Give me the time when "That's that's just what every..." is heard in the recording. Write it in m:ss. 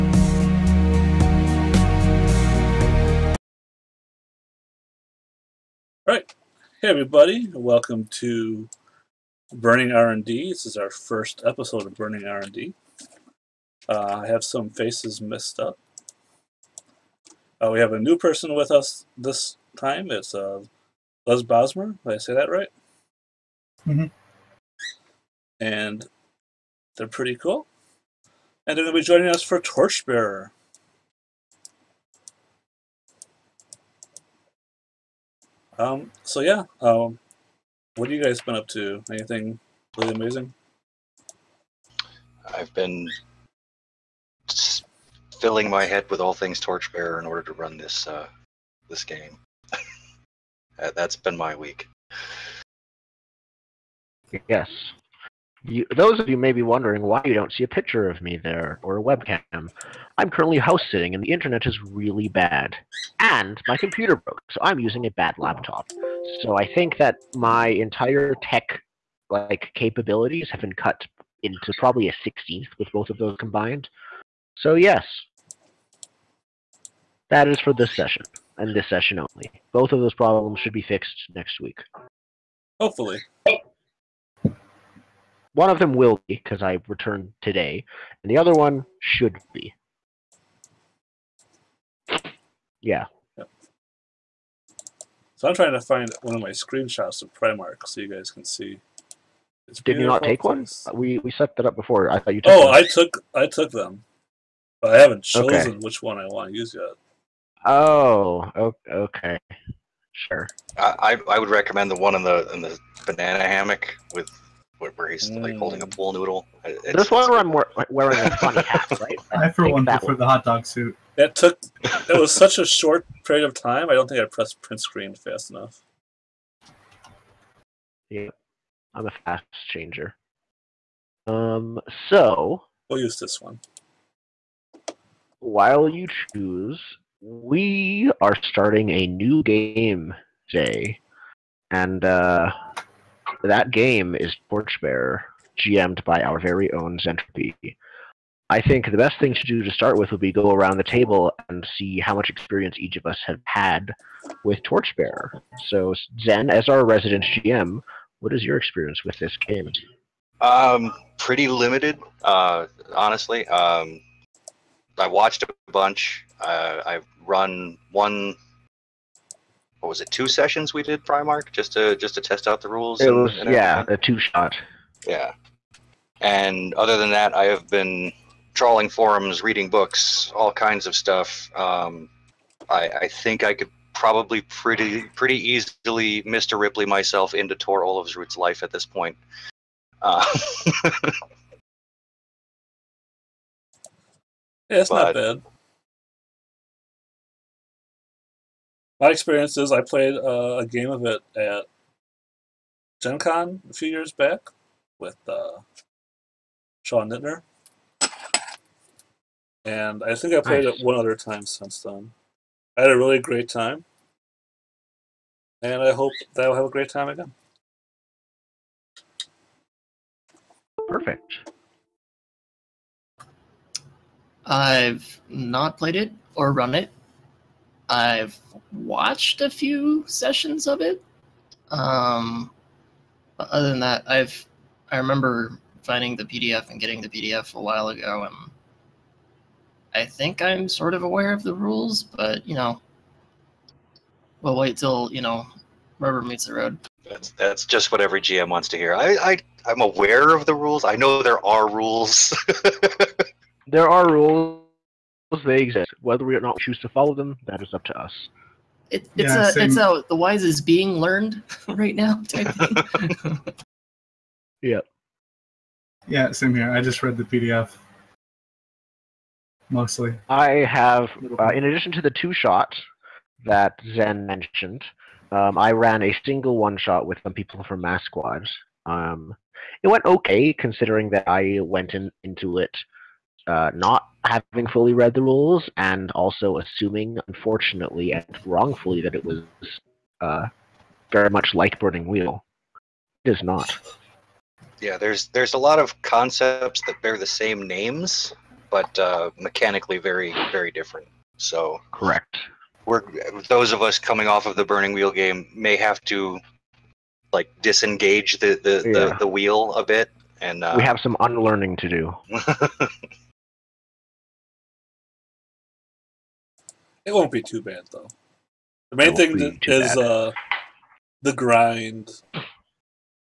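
4:07.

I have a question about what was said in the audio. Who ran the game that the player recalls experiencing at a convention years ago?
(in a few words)
Sean Nittner.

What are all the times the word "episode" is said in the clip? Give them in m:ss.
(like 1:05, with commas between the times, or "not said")
0:11.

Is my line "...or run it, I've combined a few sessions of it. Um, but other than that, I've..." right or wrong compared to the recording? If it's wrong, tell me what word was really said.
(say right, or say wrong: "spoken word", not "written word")
wrong: "watched", not "combined".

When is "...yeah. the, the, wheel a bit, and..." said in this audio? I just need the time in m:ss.
5:08.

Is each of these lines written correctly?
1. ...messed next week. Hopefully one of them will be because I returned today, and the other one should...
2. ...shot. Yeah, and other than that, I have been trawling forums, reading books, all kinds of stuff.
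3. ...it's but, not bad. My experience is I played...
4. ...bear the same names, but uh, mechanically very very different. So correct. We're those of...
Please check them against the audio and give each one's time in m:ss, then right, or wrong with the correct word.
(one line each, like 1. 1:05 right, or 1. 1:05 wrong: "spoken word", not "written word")
1. 1:20 wrong: "fixed", not "messed"
2. 2:54 right
3. 3:14 right
4. 4:57 right.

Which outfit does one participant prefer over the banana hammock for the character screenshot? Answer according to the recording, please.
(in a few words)
hot dog suit.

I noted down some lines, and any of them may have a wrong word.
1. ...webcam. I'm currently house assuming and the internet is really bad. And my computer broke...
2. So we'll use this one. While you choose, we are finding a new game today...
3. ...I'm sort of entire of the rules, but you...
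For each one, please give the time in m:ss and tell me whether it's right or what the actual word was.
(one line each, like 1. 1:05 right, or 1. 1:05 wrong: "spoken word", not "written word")
1. 0:59 wrong: "sitting", not "assuming"
2. 2:12 wrong: "starting", not "finding"
3. 4:00 wrong: "aware", not "entire".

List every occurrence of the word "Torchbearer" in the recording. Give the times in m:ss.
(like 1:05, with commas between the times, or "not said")
0:29, 0:46, 2:24, 2:34.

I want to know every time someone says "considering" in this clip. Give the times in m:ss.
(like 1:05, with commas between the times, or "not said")
4:40.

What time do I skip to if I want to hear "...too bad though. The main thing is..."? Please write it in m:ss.
5:17.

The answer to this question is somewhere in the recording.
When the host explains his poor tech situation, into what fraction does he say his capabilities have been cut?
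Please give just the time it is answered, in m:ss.
1:12.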